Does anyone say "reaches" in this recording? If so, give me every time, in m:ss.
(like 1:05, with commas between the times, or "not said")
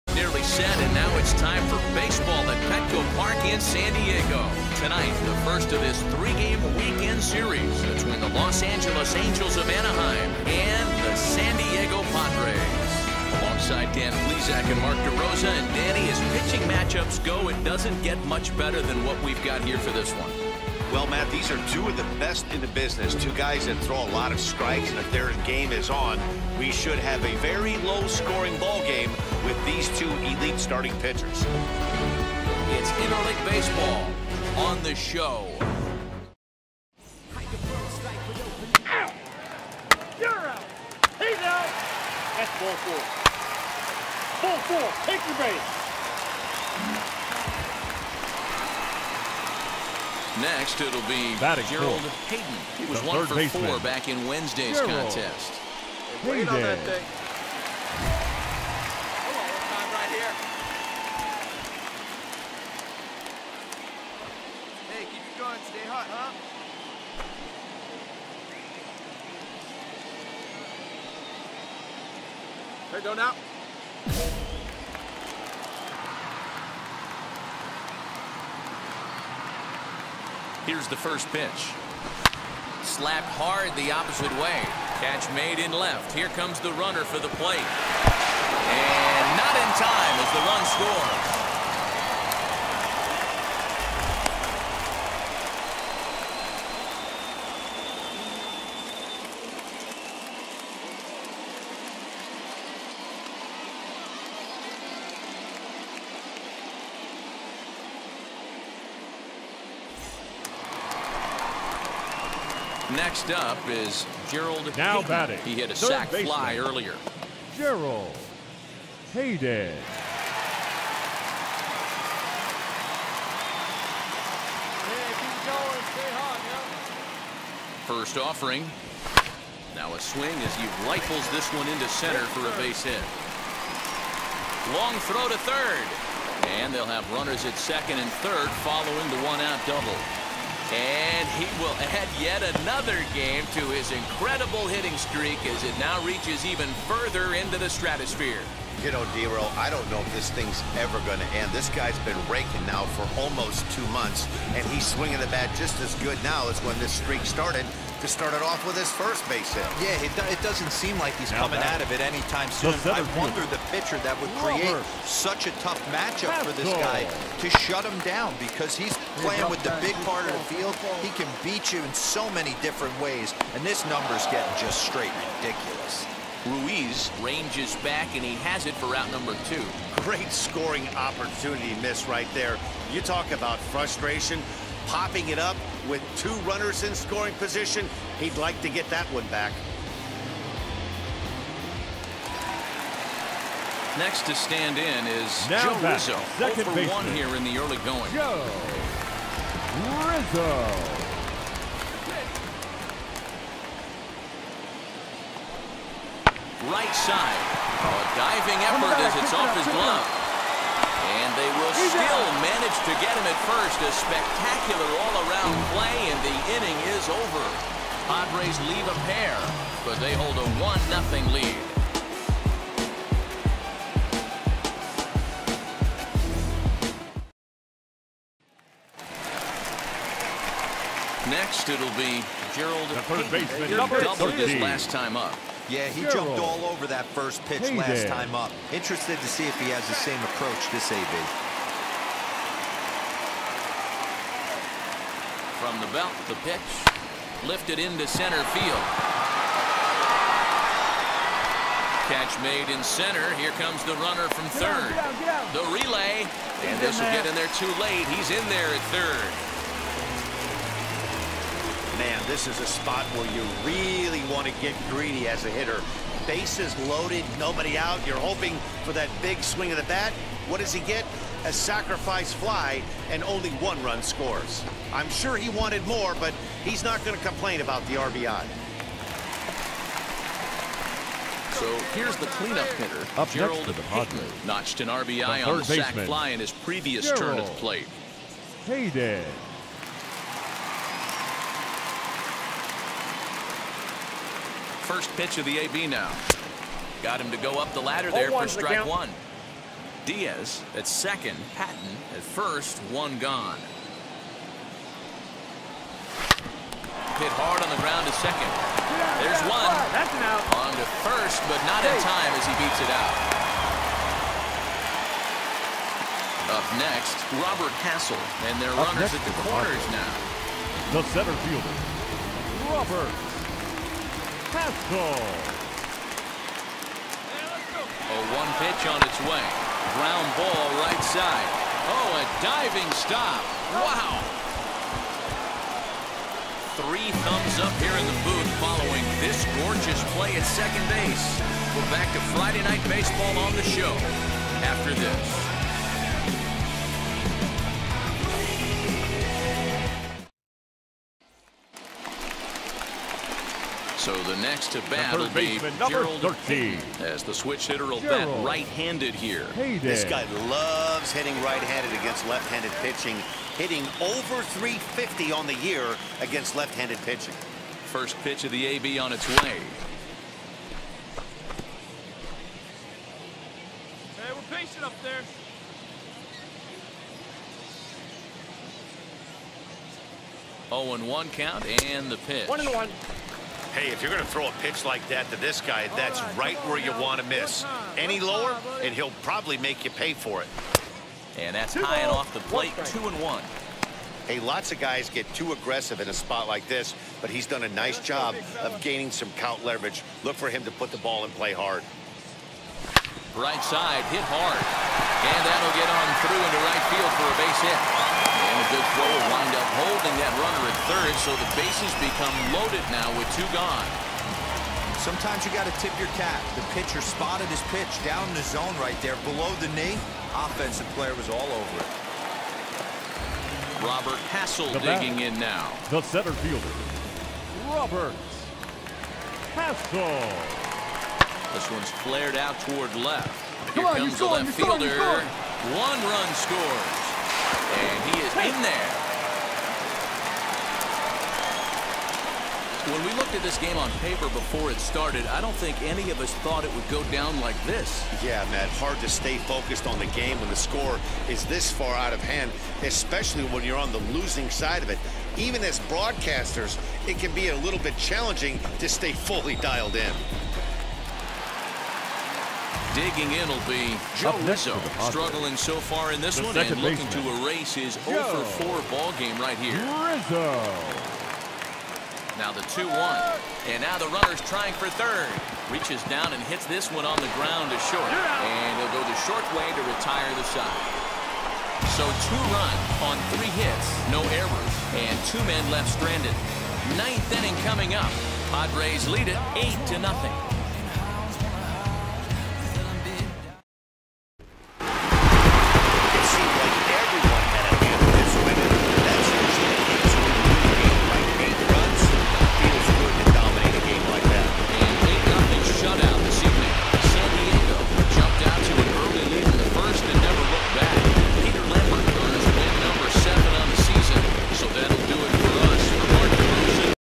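2:26, 7:55.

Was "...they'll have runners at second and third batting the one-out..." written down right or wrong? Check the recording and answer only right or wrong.
wrong.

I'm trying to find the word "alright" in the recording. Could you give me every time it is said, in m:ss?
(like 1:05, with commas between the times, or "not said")
not said.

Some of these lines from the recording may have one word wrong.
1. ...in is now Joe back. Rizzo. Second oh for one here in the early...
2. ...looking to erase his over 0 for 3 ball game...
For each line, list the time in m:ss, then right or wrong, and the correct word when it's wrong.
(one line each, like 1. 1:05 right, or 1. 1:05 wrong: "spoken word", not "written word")
1. 3:14 right
2. 7:46 wrong: "4", not "3".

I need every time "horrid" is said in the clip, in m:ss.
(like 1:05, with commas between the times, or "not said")
not said.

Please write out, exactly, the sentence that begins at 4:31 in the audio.
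A sacrifice fly, and only one run scores.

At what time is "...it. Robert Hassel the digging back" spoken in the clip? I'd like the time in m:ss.
7:01.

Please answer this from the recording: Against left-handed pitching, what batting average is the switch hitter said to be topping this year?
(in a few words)
350.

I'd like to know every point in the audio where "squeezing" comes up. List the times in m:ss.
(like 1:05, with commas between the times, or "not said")
not said.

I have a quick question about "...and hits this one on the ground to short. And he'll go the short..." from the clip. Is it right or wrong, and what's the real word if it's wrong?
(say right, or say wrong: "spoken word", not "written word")
right.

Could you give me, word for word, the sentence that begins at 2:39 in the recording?
Yeah, it, do it doesn't seem like he's now coming out of it anytime soon.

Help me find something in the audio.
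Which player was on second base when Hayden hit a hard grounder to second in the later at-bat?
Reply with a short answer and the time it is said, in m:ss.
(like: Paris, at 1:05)
Diaz, at 5:00.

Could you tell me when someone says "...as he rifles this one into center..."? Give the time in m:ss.
2:10.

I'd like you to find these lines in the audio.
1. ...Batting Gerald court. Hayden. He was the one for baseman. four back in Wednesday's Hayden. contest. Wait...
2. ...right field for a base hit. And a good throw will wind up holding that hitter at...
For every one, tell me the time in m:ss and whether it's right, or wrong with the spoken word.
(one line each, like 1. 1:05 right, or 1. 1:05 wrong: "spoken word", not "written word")
1. 0:51 wrong: "Gerald", not "Hayden"
2. 6:46 wrong: "runner", not "hitter".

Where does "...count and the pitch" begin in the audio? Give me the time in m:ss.
6:21.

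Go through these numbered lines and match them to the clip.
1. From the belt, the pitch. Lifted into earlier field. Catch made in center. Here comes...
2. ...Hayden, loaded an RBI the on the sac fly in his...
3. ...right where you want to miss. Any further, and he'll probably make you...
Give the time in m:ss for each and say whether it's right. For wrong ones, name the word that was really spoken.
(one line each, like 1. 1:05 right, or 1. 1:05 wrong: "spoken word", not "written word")
1. 4:05 wrong: "center", not "earlier"
2. 4:43 wrong: "notched", not "loaded"
3. 6:26 wrong: "lower", not "further".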